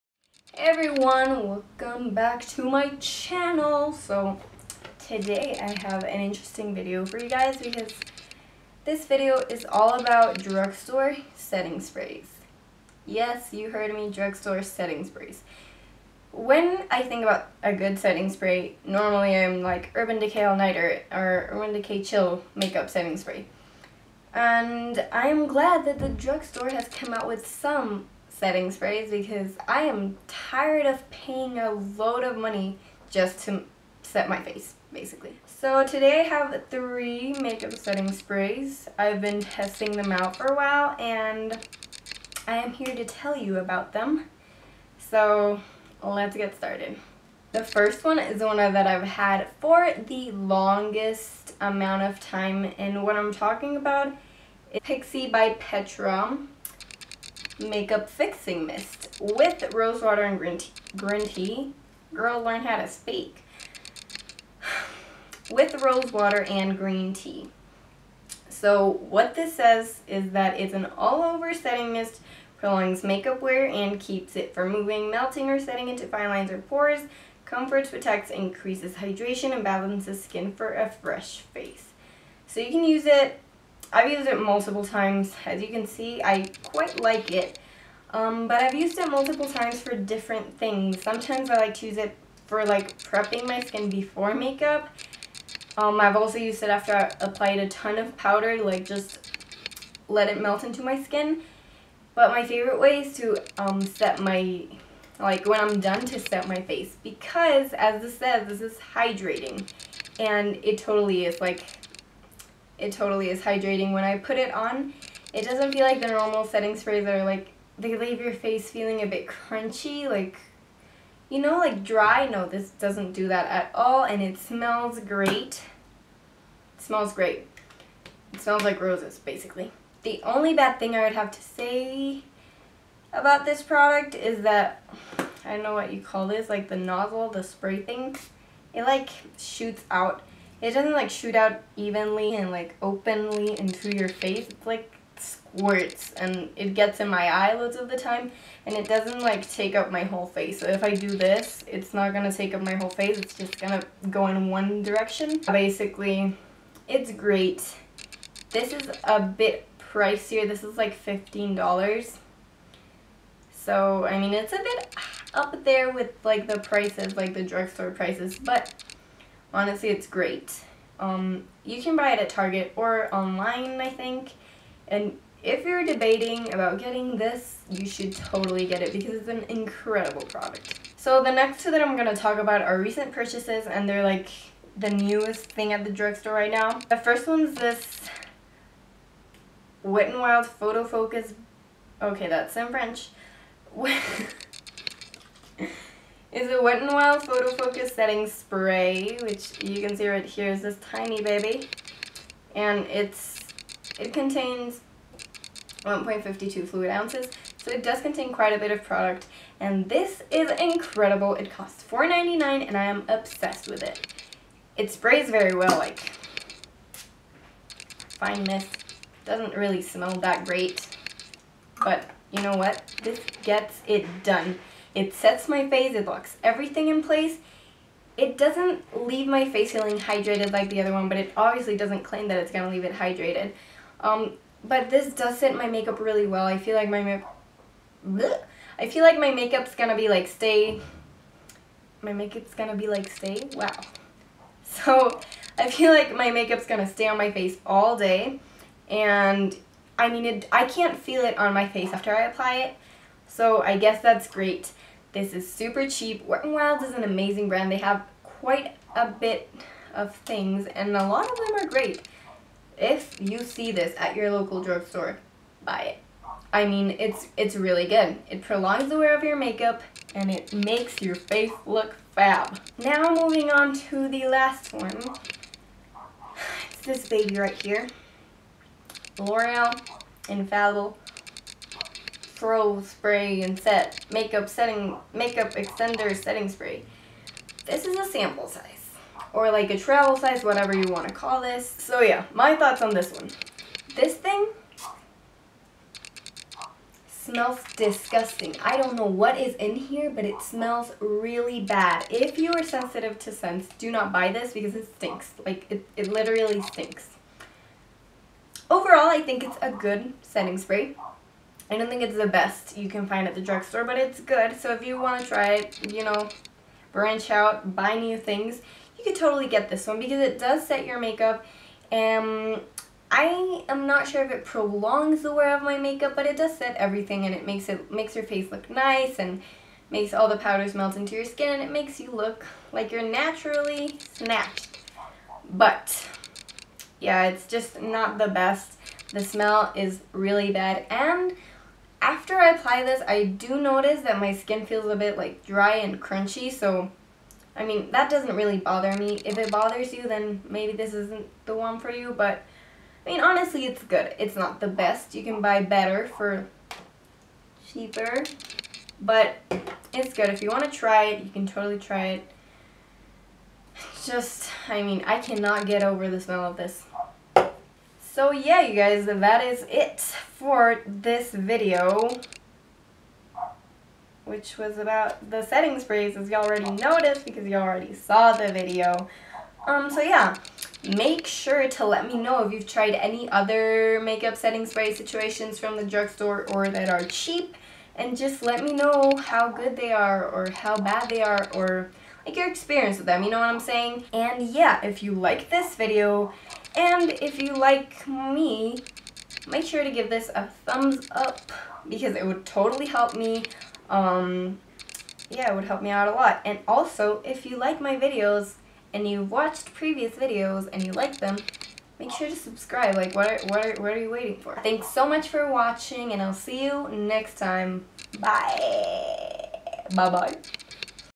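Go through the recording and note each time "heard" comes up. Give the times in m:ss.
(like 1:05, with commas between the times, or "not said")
0:13.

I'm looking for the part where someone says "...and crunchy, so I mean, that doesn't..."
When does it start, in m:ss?
5:45.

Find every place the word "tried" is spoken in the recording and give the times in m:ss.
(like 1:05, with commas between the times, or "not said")
6:22.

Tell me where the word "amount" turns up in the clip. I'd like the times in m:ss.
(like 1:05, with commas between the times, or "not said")
0:51.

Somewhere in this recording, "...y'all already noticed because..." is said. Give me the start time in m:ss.
6:16.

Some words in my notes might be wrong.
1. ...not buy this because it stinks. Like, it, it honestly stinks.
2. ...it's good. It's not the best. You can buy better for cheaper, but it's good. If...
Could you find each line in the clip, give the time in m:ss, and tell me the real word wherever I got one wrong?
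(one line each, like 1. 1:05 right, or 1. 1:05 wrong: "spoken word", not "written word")
1. 5:03 wrong: "literally", not "honestly"
2. 5:53 right.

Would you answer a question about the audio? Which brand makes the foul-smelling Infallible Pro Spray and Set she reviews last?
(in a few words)
L'Oreal.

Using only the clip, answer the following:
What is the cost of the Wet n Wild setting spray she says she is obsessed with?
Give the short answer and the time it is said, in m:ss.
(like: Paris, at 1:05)
$4.99, at 3:31.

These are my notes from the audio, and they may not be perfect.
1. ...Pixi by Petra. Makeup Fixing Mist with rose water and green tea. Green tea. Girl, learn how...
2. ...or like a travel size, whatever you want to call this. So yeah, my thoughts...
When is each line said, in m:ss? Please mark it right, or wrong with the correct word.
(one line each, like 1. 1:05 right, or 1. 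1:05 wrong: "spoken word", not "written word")
1. 0:54 right
2. 4:49 right.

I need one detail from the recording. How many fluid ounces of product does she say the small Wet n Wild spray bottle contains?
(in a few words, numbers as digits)
1.52.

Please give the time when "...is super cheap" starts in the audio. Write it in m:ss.
4:15.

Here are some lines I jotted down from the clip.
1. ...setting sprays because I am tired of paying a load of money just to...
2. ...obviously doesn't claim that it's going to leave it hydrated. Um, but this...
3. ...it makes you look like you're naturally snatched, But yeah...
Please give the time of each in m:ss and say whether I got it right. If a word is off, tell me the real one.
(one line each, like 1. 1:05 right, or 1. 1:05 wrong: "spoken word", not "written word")
1. 0:28 right
2. 3:51 right
3. 5:31 right.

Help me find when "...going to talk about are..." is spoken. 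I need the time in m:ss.
3:01.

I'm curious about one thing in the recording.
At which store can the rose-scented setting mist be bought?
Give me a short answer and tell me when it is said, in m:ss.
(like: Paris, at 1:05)
Target, at 2:52.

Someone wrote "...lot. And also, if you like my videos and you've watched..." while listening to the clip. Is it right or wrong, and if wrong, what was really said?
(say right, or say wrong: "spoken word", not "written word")
right.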